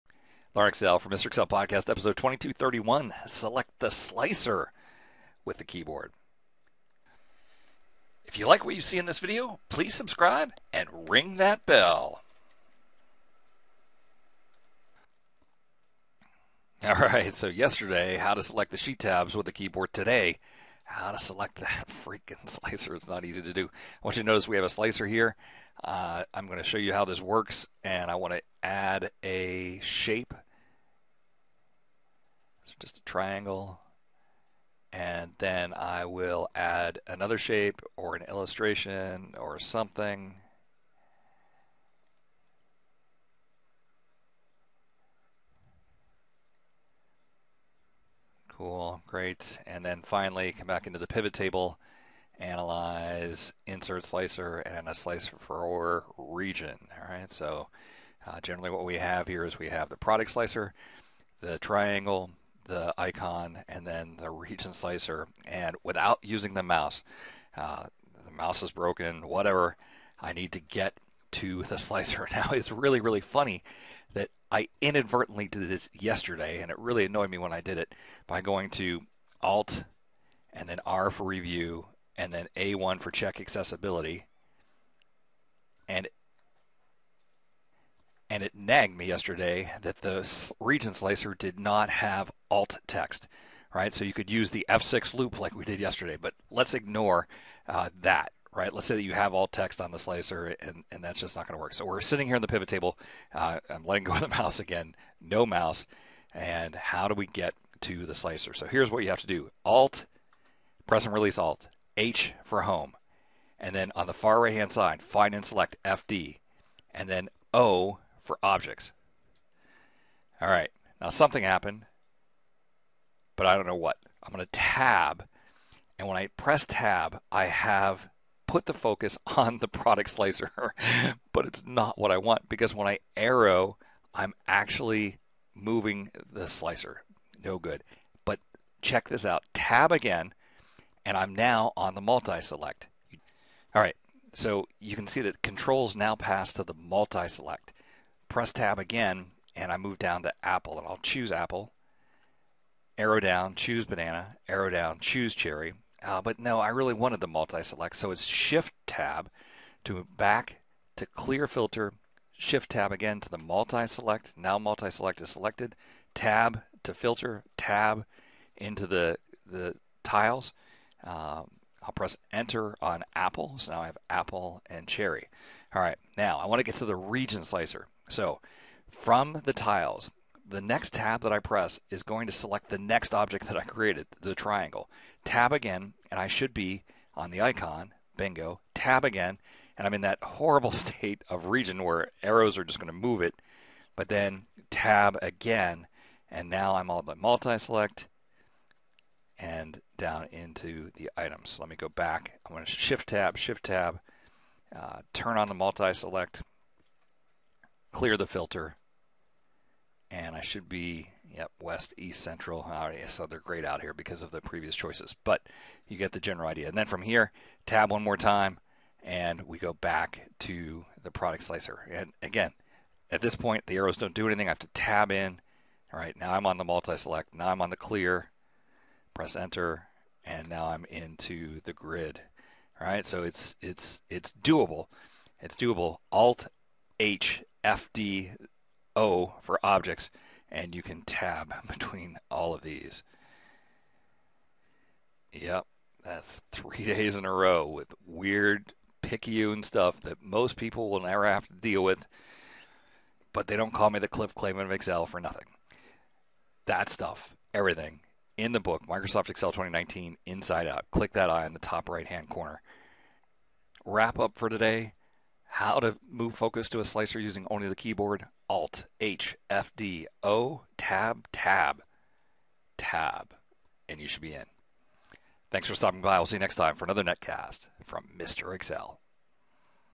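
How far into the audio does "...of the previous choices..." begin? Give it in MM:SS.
03:34.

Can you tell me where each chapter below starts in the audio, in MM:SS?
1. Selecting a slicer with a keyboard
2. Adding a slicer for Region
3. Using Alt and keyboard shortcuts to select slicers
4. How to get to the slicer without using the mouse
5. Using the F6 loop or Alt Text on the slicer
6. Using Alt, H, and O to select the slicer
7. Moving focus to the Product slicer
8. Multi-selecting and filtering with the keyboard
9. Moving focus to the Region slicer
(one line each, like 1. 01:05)
1. 00:21
2. 00:39
3. 00:57
4. 01:12
5. 01:33
6. 01:46
7. 02:04
8. 02:33
9. 03:09.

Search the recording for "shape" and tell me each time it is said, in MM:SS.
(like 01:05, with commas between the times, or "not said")
00:29, 00:37.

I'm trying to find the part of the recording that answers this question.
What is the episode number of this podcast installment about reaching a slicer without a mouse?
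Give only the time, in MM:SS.
00:02.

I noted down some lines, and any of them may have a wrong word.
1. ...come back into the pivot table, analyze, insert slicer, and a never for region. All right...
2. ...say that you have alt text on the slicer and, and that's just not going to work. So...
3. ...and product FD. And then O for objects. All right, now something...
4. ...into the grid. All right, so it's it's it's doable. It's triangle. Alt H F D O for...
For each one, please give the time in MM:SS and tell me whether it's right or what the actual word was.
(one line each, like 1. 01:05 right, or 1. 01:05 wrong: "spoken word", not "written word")
1. 00:50 wrong: "slicer", not "never"
2. 01:38 right
3. 01:55 wrong: "select", not "product"
4. 03:50 wrong: "doable", not "triangle".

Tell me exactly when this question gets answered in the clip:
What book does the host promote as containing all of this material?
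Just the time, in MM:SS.
04:18.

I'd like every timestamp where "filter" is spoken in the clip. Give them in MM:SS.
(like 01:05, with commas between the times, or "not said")
02:41, 02:46, 03:28.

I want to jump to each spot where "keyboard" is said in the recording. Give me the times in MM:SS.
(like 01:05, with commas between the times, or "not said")
00:05, 00:19, 04:27.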